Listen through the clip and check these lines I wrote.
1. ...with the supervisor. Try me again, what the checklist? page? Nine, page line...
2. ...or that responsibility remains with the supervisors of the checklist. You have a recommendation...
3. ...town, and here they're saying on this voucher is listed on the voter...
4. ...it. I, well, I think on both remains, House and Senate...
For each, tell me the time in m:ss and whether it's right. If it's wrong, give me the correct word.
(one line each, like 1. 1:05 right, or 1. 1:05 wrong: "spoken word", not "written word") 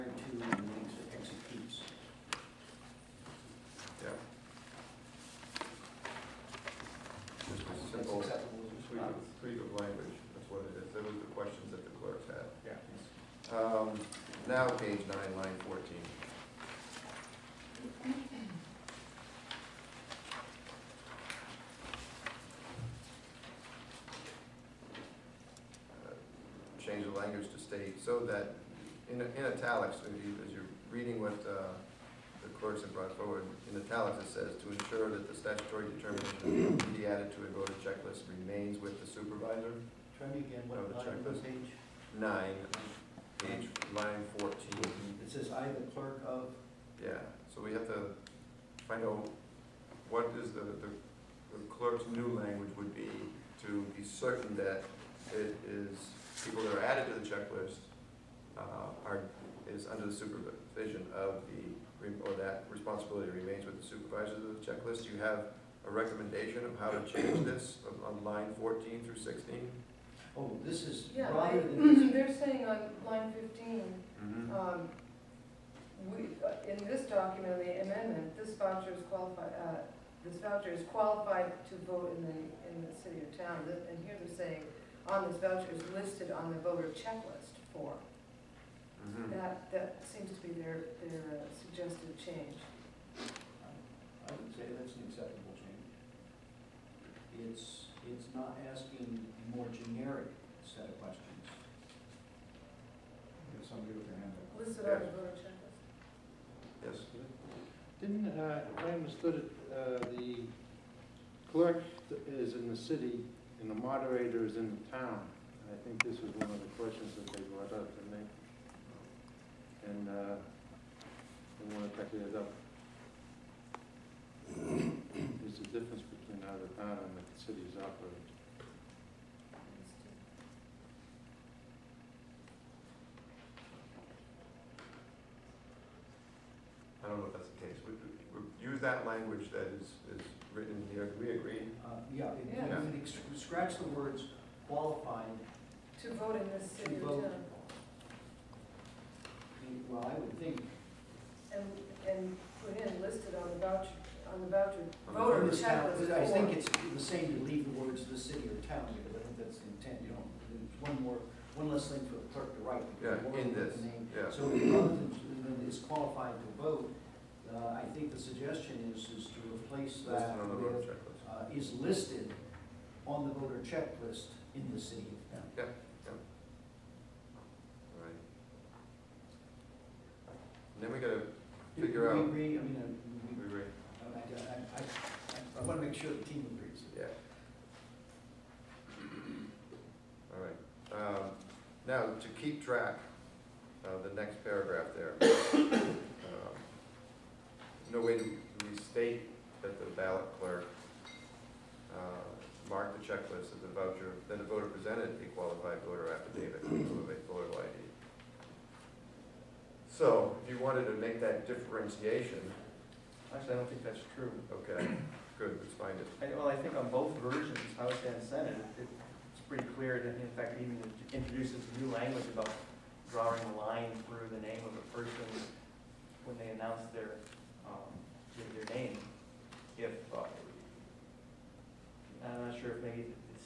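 1. 0:38 right
2. 1:02 right
3. 1:23 right
4. 3:35 wrong: "versions", not "remains".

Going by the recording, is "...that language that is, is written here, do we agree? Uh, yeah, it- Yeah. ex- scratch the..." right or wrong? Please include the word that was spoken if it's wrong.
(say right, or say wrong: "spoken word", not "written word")
right.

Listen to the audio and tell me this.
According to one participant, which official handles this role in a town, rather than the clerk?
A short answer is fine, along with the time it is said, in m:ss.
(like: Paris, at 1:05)
the moderator, at 1:53.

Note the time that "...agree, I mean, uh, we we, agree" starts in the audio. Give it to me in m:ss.
3:02.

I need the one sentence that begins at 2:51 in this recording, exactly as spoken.
uh, is listed on the voter checklist in the city Yeah, yeah.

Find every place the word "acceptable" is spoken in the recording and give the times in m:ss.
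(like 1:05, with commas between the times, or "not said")
0:07, 1:35.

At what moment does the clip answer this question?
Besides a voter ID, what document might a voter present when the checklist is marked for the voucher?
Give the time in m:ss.
3:25.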